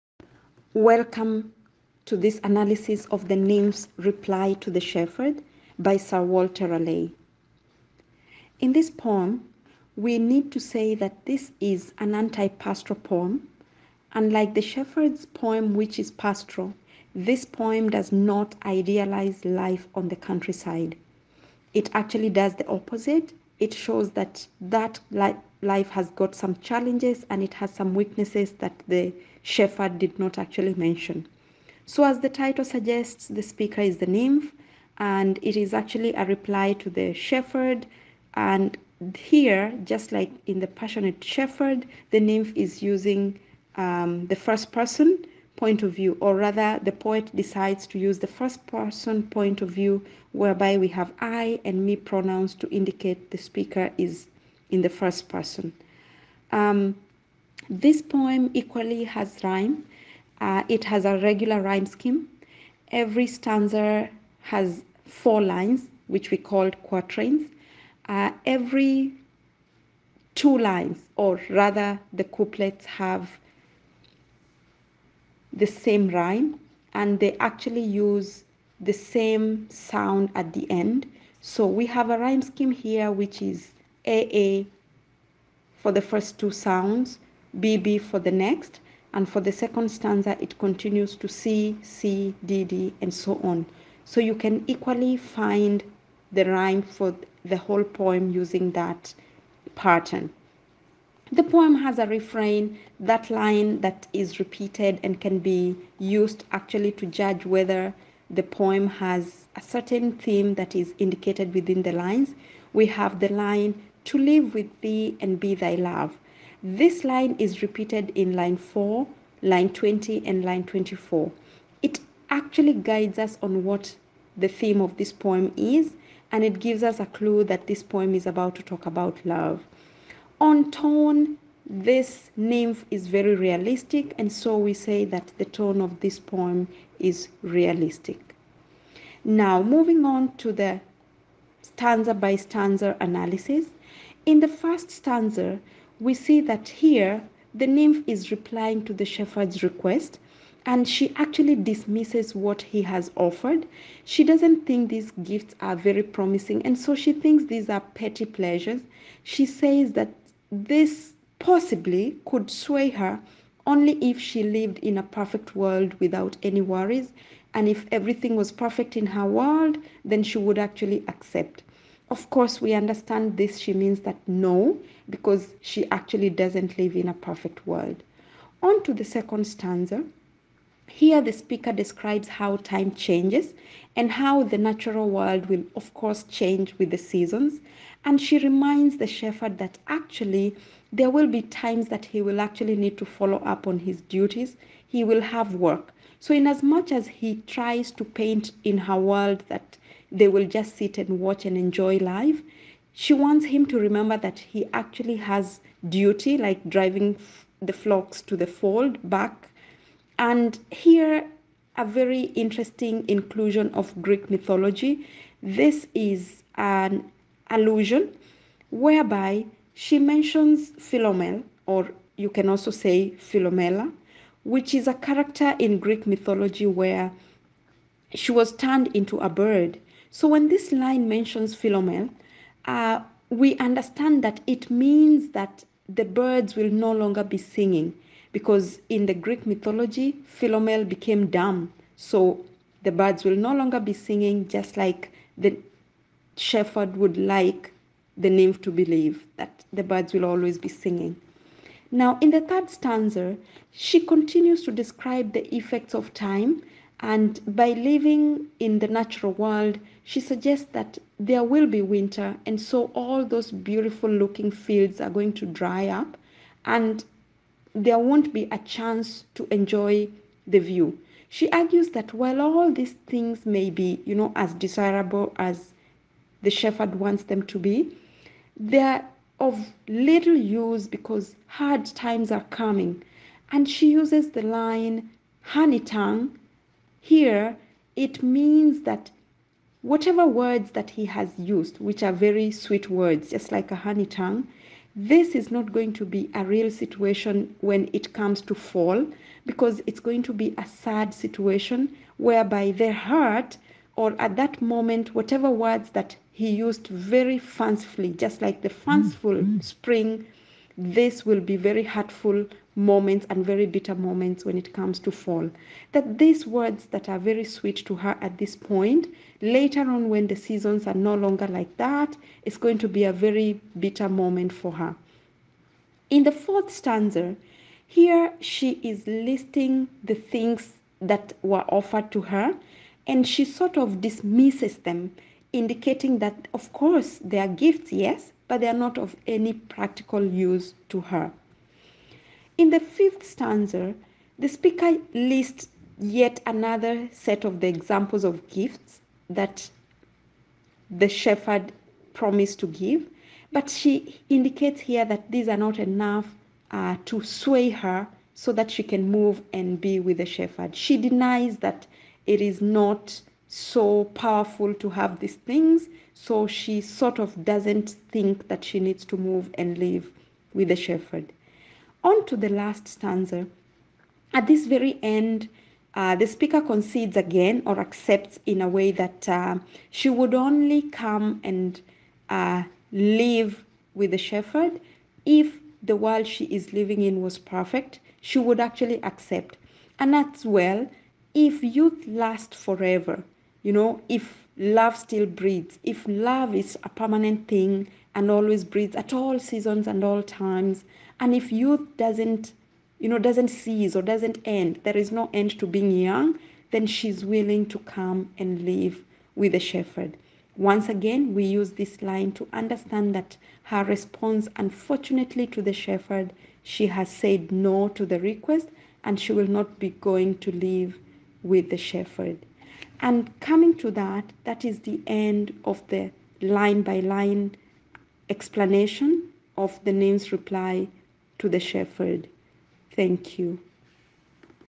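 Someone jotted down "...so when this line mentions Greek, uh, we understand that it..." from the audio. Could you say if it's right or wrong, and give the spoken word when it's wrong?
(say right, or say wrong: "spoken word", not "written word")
wrong: "Philomel", not "Greek".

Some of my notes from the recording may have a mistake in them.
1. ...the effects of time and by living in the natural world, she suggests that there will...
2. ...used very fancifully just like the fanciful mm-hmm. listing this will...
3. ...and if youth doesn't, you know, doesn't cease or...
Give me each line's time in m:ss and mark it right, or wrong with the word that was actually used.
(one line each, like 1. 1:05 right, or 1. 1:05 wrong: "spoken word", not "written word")
1. 4:15 right
2. 5:06 wrong: "spring", not "listing"
3. 6:41 right.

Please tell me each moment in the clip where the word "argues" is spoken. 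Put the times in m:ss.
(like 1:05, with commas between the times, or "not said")
4:31.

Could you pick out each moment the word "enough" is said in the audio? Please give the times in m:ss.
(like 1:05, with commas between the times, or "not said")
5:55.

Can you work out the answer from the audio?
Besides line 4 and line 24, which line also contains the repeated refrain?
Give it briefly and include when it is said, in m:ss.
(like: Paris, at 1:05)
Line 20, at 1:59.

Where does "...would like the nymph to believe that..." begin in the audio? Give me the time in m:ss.
4:06.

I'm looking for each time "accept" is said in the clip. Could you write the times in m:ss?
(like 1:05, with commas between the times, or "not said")
2:51, 6:17, 6:29.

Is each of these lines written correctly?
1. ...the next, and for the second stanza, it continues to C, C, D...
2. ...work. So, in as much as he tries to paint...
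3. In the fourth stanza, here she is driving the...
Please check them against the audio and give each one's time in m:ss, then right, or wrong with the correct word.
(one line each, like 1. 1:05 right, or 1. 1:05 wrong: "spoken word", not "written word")
1. 1:28 right
2. 3:15 right
3. 5:26 wrong: "listing", not "driving".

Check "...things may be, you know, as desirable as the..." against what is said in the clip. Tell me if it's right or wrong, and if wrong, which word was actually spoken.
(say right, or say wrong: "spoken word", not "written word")
right.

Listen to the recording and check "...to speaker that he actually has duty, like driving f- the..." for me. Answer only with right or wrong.
wrong.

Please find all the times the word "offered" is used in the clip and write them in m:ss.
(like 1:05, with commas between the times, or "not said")
2:33, 5:31.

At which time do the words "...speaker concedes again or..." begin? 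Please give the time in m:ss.
6:16.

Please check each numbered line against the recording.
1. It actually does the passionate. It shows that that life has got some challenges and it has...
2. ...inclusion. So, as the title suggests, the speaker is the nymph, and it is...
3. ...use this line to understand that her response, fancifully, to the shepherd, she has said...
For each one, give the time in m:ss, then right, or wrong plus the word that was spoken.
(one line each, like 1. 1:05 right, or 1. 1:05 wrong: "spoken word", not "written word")
1. 0:21 wrong: "opposite", not "passionate"
2. 0:30 wrong: "mention", not "inclusion"
3. 6:51 wrong: "unfortunately", not "fancifully".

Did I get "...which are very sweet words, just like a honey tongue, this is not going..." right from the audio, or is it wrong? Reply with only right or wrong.
right.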